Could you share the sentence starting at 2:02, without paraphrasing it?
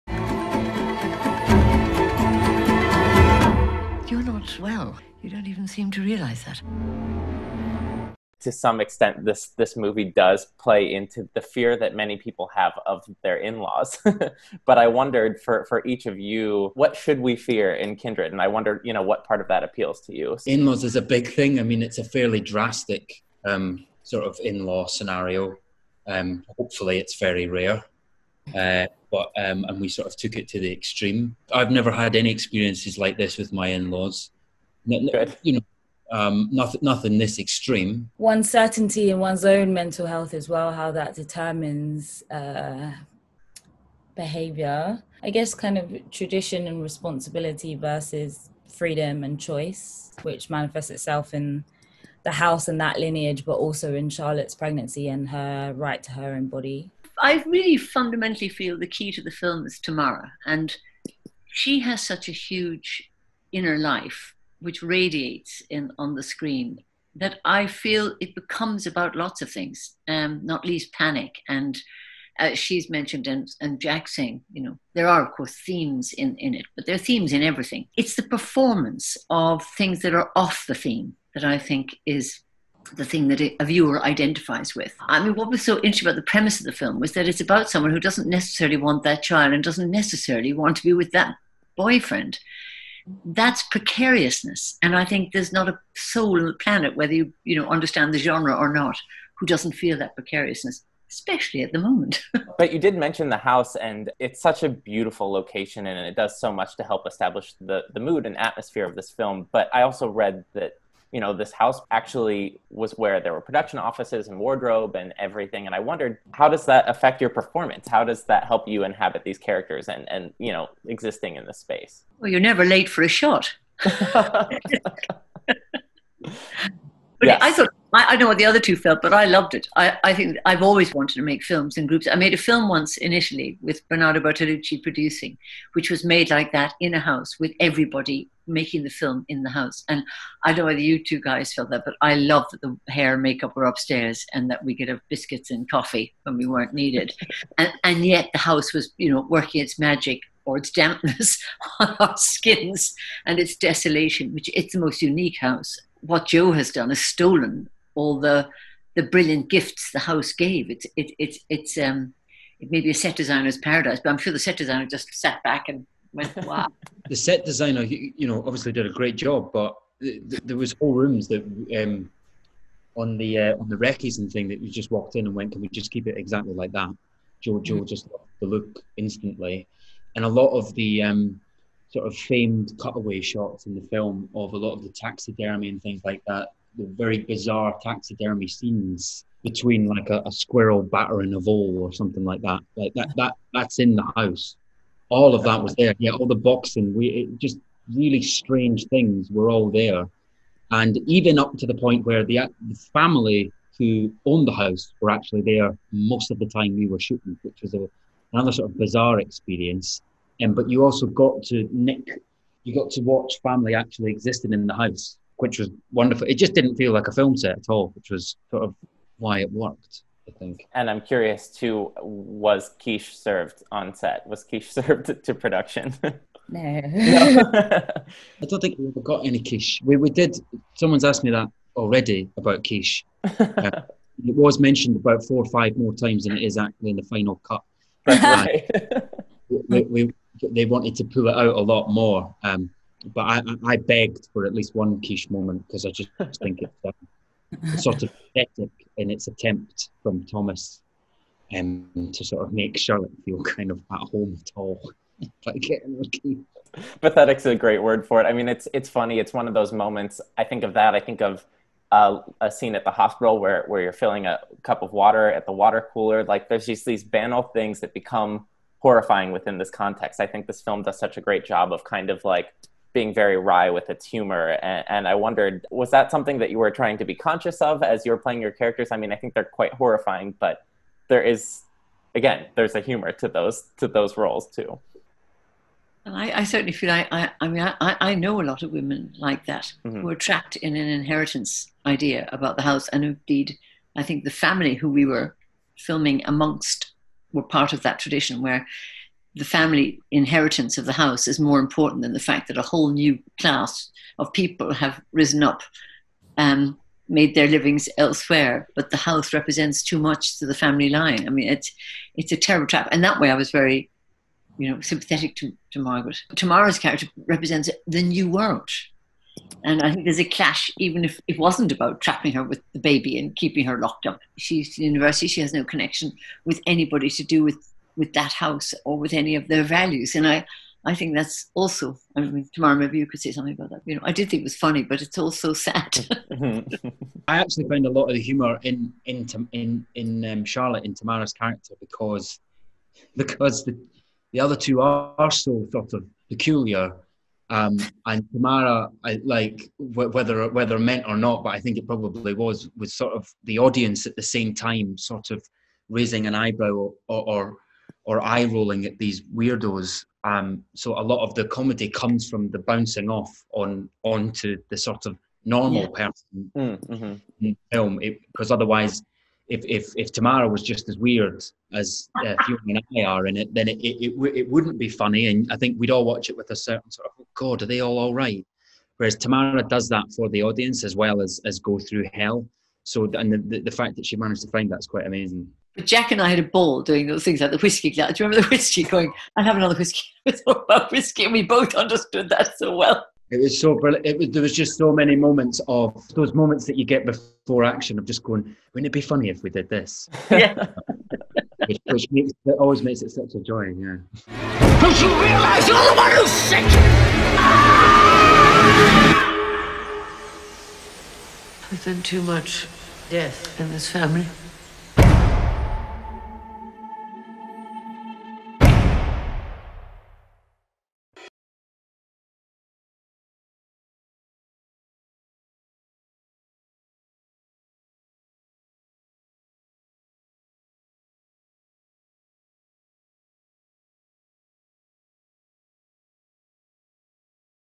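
Well, you're never late for a shot.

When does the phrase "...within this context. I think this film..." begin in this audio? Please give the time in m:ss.
4:29.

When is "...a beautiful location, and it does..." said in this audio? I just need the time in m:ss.
1:44.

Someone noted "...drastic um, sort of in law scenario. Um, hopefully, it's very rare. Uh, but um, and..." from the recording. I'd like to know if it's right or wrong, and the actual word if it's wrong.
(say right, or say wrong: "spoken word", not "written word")
right.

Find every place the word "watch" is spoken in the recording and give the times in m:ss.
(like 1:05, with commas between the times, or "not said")
3:33, 6:16.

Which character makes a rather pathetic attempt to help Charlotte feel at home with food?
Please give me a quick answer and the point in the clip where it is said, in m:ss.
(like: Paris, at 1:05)
Thomas, at 4:10.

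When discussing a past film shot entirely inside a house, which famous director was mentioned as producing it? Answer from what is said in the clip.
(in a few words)
Bernardo Bertolucci.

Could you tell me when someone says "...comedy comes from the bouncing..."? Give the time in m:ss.
6:01.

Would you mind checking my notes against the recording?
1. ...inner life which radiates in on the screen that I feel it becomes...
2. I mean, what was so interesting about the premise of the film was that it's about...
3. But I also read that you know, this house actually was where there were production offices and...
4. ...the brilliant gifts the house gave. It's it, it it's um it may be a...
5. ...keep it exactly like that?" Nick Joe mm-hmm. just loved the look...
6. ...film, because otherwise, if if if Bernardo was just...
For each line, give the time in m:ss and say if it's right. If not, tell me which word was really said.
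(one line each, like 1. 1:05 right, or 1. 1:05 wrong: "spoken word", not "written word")
1. 1:03 right
2. 1:25 right
3. 1:49 right
4. 2:38 right
5. 2:55 wrong: "Joe", not "Nick"
6. 6:07 wrong: "Tamara", not "Bernardo".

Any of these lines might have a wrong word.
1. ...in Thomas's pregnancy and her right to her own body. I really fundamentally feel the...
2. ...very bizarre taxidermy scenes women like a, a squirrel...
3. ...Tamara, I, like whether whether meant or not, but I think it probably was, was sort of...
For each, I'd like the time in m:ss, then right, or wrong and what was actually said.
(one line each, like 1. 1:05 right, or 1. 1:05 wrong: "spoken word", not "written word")
1. 0:53 wrong: "Charlotte", not "Thomas"
2. 3:06 wrong: "between", not "women"
3. 5:48 right.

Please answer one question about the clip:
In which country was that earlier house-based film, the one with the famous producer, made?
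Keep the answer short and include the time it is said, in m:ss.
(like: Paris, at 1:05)
Italy, at 2:13.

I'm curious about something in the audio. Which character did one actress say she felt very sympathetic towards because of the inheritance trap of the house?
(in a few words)
Margaret.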